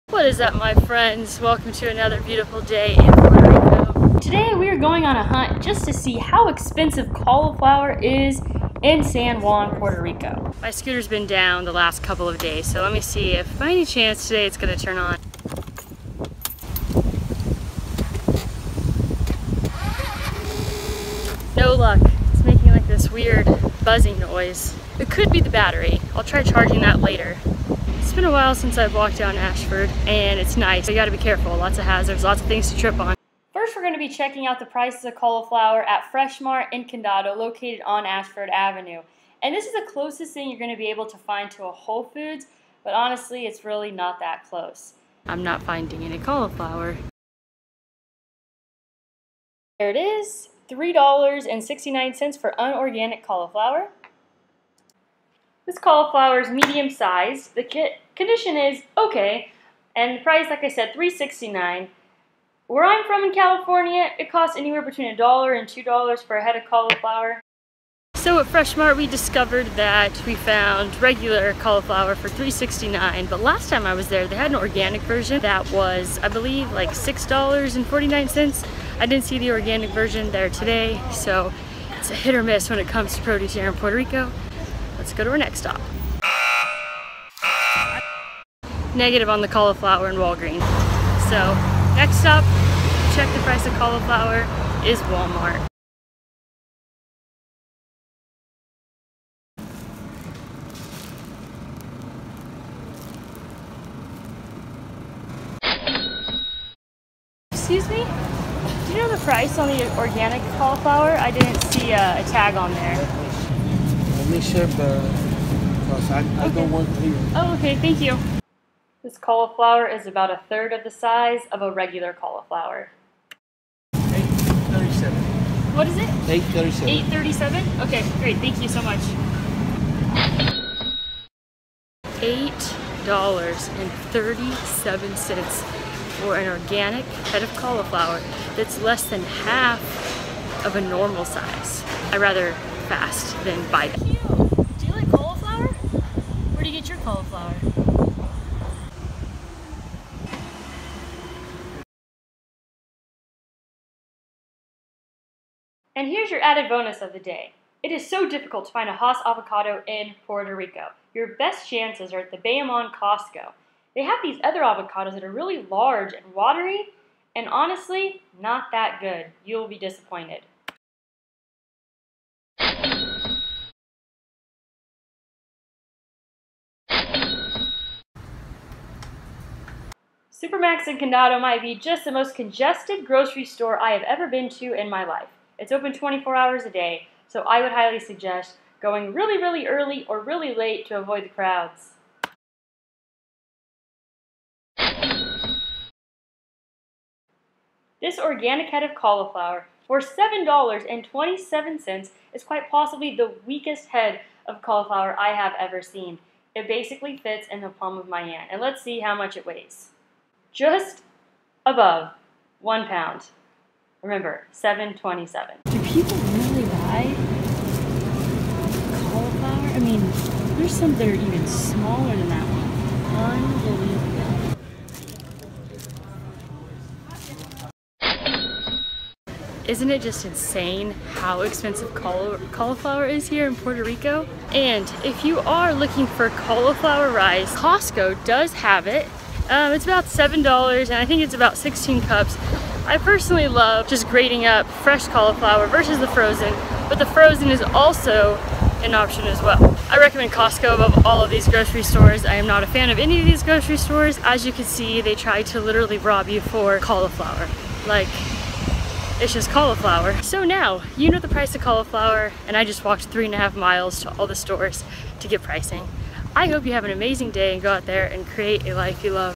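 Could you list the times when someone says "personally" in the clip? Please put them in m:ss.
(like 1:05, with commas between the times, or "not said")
4:02.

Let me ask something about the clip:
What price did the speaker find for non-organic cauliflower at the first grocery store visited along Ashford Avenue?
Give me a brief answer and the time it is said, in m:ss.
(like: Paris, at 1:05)
$3.69, at 0:50.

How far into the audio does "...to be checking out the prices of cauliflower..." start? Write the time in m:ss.
0:33.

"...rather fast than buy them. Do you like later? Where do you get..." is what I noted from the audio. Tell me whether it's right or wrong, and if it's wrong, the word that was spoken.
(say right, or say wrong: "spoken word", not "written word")
wrong: "cauliflower", not "later".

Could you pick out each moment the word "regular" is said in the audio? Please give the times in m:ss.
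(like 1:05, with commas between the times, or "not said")
1:11, 2:01.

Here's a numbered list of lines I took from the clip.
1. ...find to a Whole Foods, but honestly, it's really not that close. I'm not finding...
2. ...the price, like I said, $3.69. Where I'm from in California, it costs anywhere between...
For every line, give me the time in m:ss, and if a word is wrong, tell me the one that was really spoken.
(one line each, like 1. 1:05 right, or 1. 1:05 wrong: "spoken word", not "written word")
1. 0:41 right
2. 1:00 right.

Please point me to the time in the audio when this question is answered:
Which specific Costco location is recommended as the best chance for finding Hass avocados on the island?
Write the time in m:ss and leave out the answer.
2:42.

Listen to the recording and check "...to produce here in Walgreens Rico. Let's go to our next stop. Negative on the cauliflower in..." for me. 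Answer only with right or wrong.
wrong.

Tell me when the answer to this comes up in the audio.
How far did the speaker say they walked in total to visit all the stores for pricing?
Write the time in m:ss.
4:23.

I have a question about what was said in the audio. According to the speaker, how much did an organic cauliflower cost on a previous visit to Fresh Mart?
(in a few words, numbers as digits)
$6.49.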